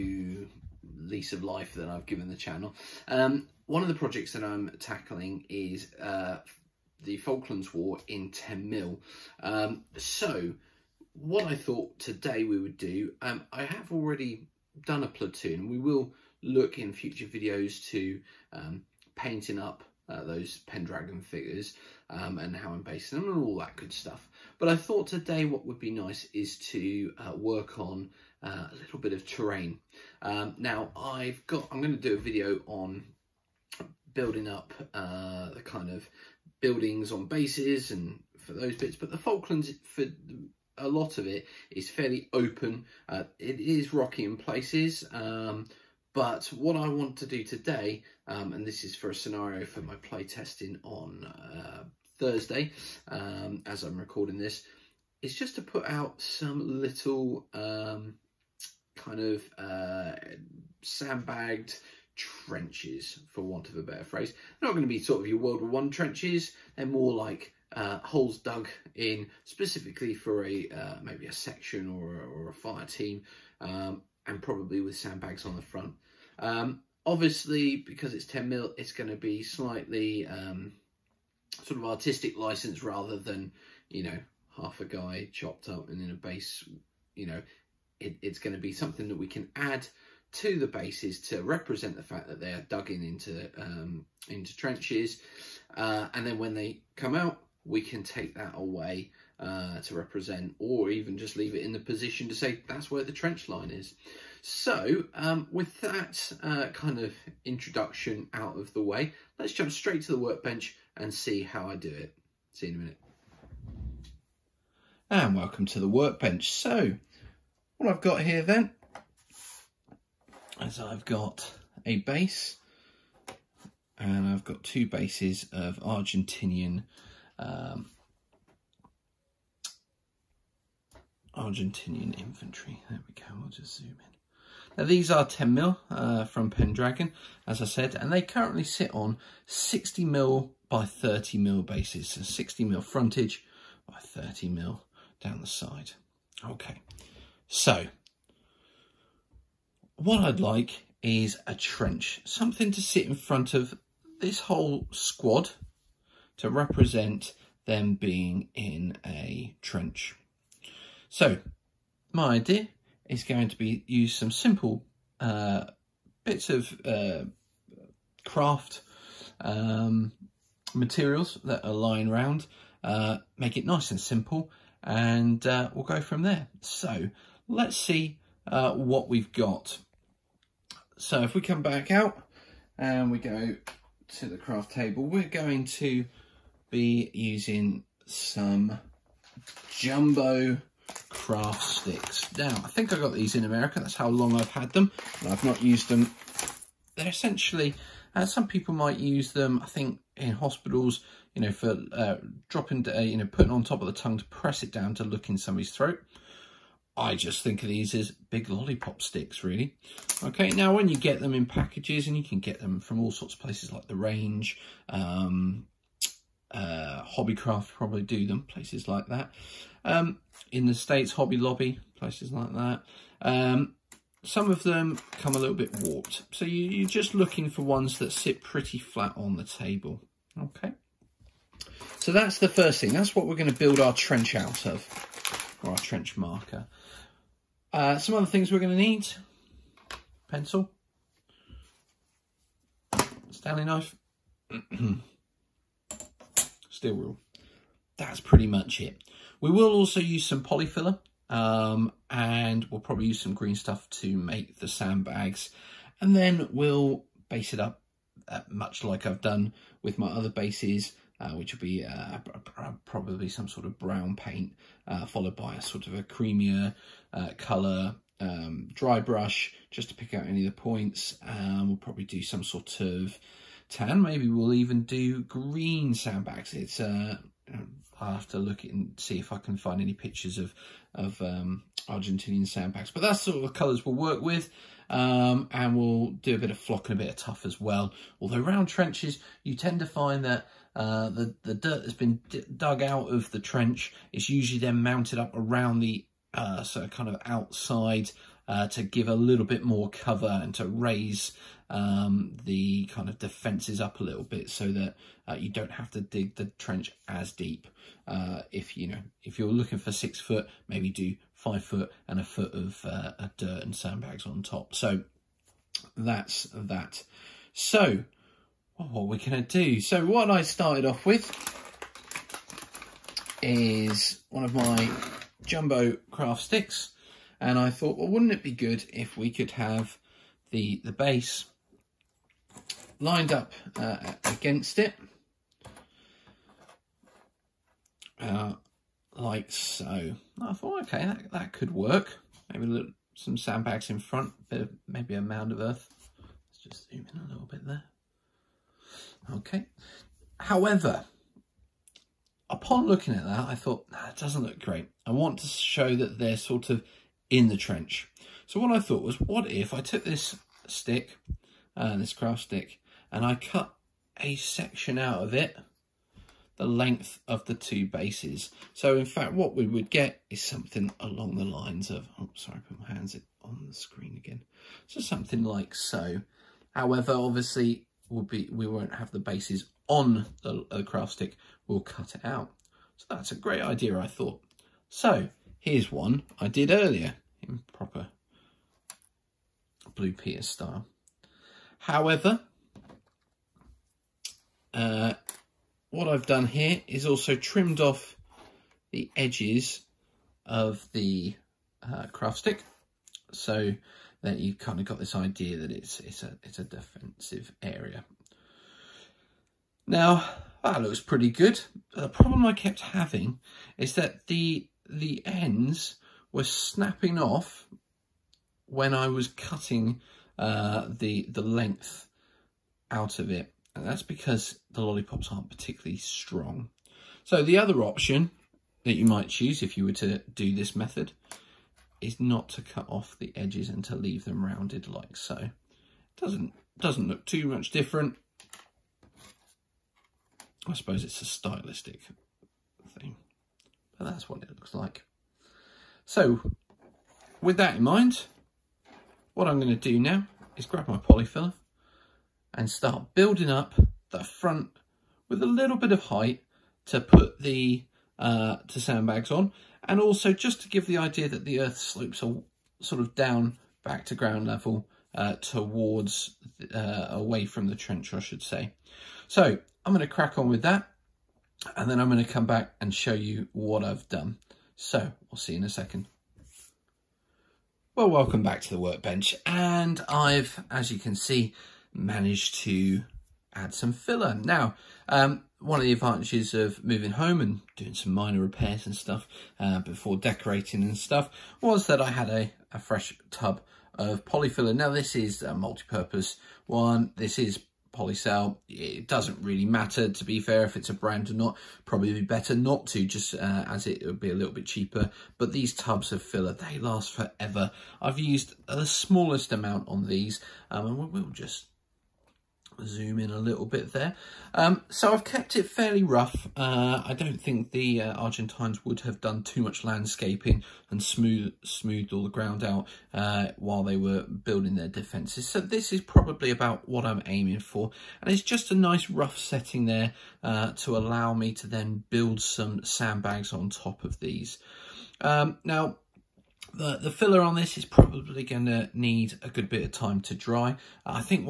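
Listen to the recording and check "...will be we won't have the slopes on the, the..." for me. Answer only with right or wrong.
wrong.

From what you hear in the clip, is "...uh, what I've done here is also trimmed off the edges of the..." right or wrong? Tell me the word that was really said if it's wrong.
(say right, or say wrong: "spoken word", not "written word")
right.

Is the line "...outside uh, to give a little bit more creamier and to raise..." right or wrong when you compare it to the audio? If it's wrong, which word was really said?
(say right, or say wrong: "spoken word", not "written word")
wrong: "cover", not "creamier".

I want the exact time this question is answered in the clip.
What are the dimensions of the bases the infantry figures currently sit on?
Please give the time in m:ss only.
2:19.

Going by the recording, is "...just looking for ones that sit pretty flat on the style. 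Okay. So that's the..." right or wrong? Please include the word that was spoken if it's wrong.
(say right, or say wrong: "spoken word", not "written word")
wrong: "table", not "style".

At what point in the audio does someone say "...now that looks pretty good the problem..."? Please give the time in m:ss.
6:49.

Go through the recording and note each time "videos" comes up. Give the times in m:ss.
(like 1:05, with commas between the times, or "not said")
0:17, 0:32.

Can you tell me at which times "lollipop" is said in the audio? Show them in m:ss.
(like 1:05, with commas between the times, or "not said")
3:28, 7:04.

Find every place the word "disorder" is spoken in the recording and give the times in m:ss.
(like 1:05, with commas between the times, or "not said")
not said.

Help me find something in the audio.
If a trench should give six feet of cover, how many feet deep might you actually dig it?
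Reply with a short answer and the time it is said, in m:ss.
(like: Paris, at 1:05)
5 foot, at 5:11.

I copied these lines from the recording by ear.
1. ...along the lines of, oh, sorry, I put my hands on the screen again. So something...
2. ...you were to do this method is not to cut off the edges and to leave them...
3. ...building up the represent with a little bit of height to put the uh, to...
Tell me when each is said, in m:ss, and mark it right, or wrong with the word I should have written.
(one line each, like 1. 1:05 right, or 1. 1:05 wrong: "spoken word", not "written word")
1. 6:10 right
2. 7:09 right
3. 7:33 wrong: "front", not "represent".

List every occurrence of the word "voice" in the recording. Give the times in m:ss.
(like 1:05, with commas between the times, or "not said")
not said.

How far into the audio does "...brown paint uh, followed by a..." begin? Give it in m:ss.
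4:23.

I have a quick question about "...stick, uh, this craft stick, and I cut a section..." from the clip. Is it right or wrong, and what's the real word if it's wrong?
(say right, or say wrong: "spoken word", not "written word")
right.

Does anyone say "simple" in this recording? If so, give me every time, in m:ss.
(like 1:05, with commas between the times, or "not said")
2:44, 2:53.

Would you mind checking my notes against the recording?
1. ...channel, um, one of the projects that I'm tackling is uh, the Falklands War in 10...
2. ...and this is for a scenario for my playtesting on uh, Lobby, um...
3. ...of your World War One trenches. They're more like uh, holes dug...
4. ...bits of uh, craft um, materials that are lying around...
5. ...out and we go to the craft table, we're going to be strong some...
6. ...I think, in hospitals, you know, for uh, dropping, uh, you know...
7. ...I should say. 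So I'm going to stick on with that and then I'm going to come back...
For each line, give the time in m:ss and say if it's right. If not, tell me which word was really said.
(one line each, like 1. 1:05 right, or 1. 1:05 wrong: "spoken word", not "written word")
1. 0:02 right
2. 0:48 wrong: "Thursday", not "Lobby"
3. 1:05 right
4. 2:46 right
5. 3:01 wrong: "using", not "strong"
6. 3:19 right
7. 7:48 wrong: "crack", not "stick".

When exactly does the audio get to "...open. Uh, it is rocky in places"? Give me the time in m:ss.
0:42.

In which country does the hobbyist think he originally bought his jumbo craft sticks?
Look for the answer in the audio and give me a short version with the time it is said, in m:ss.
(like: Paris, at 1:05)
America, at 3:13.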